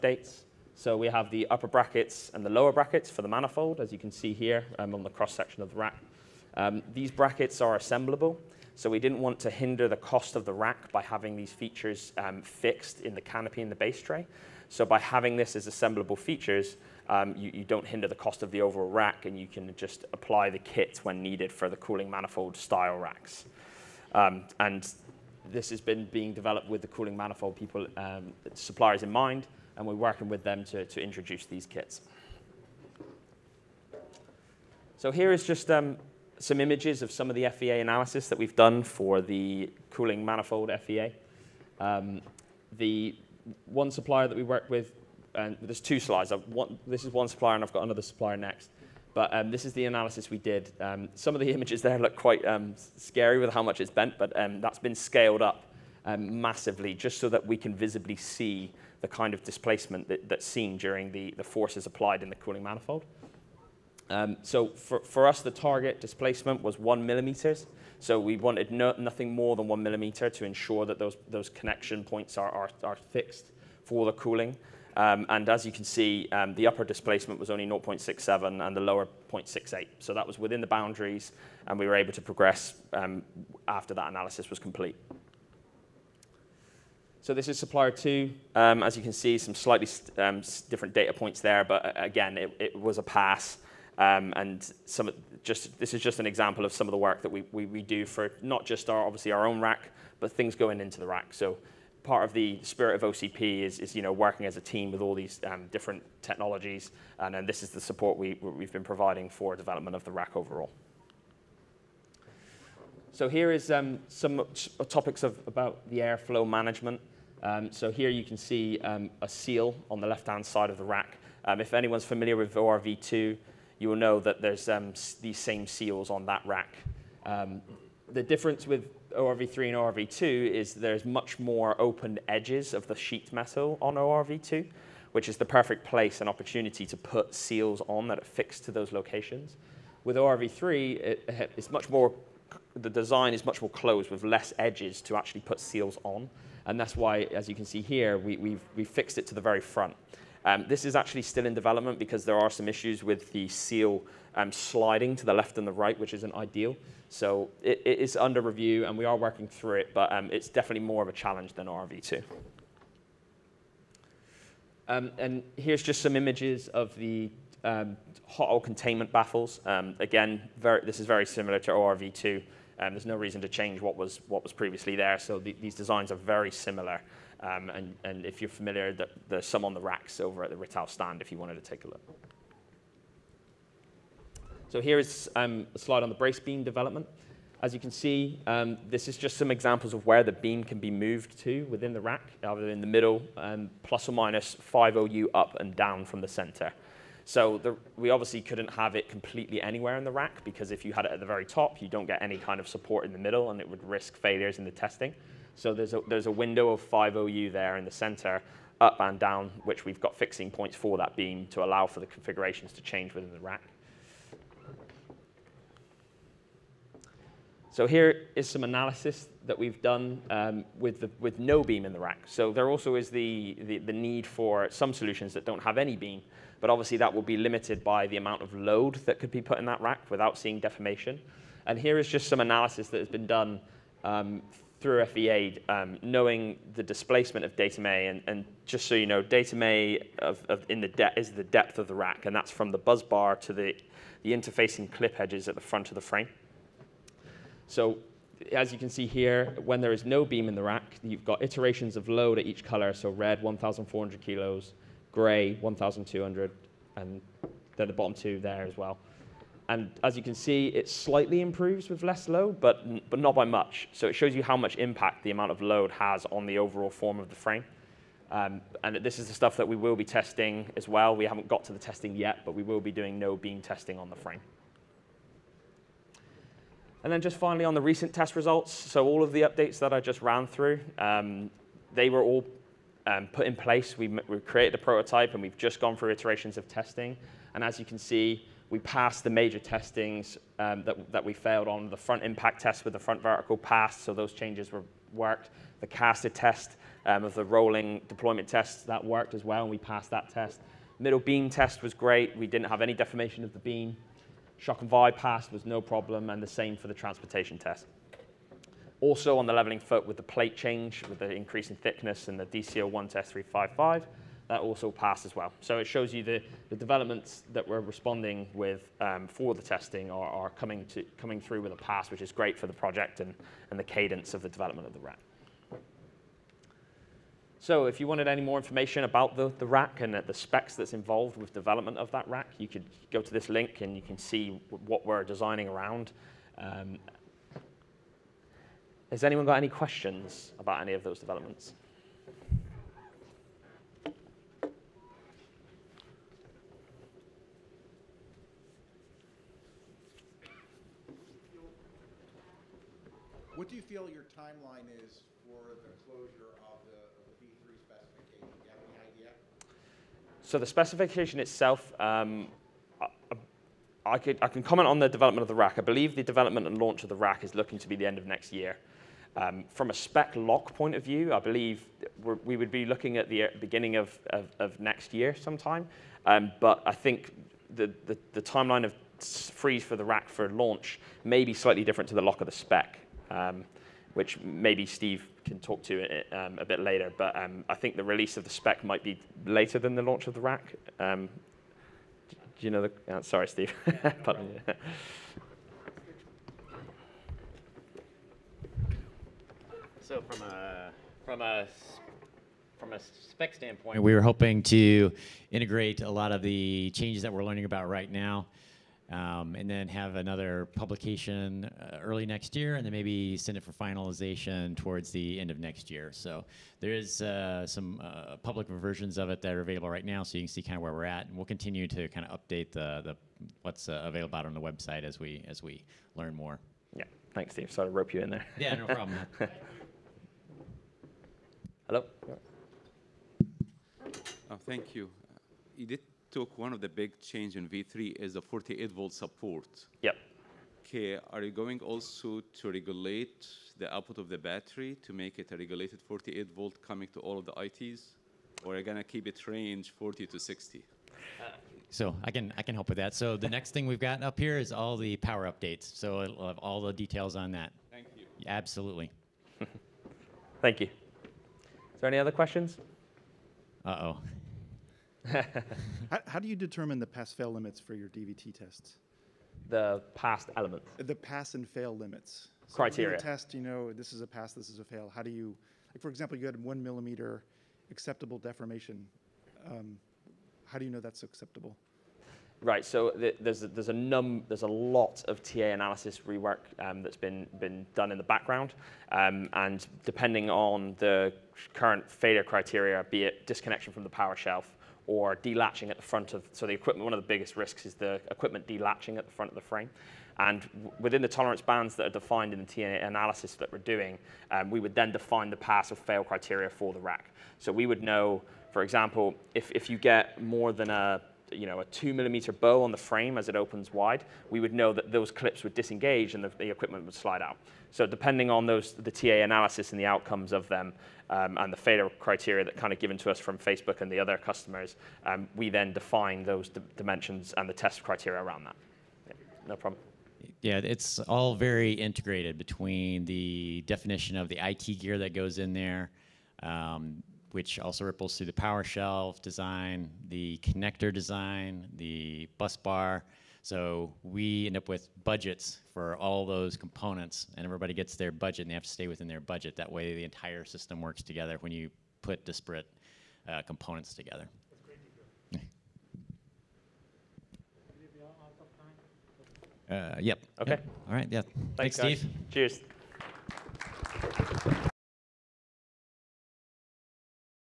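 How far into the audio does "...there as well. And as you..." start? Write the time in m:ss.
4:18.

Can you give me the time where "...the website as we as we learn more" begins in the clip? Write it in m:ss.
7:04.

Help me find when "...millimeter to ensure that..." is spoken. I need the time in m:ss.
1:09.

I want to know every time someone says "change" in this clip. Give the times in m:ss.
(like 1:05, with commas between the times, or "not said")
2:53, 3:32, 4:54, 5:10, 6:46, 7:17.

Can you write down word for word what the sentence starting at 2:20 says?
With ORV3, it, it's much more, the design is much more closed with less edges to actually put seals on.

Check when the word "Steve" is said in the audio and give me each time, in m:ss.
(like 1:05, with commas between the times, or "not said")
6:24, 6:33, 7:07, 9:22.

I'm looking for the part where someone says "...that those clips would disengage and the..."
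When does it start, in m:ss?
8:34.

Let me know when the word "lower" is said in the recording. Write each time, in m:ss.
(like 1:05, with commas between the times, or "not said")
0:02, 1:18.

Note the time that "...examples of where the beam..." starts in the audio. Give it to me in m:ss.
3:09.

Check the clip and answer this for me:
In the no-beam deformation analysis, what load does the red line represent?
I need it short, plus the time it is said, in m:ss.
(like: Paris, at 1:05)
1,400 kilos, at 4:13.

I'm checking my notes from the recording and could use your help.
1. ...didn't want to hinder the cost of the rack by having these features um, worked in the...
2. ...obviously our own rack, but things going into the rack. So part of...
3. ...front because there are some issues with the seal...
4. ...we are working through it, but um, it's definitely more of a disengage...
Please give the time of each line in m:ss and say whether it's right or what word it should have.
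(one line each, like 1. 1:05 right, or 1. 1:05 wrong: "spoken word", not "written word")
1. 0:08 wrong: "fixed", not "worked"
2. 1:39 right
3. 2:31 wrong: "development", not "front"
4. 2:38 wrong: "challenge", not "disengage".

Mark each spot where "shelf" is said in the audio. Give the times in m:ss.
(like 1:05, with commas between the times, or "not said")
8:14, 8:58.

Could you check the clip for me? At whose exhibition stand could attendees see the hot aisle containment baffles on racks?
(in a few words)
Rittal.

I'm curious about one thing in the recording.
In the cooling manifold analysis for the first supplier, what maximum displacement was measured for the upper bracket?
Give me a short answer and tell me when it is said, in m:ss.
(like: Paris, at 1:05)
0.67, at 1:17.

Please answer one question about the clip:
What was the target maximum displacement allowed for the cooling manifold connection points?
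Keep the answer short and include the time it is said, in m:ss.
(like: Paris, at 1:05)
1 millimeter, at 1:06.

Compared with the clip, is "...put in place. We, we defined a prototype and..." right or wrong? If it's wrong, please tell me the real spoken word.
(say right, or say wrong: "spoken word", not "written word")
wrong: "created", not "defined".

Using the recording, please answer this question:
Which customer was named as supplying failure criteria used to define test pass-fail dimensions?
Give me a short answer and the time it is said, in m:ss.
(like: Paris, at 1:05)
Facebook, at 8:43.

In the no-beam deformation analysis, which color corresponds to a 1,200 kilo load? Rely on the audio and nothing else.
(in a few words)
Gray.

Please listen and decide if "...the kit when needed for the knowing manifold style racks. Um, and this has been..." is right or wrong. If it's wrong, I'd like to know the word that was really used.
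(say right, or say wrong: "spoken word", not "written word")
wrong: "cooling", not "knowing".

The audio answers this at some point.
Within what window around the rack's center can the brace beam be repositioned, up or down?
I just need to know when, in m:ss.
3:14.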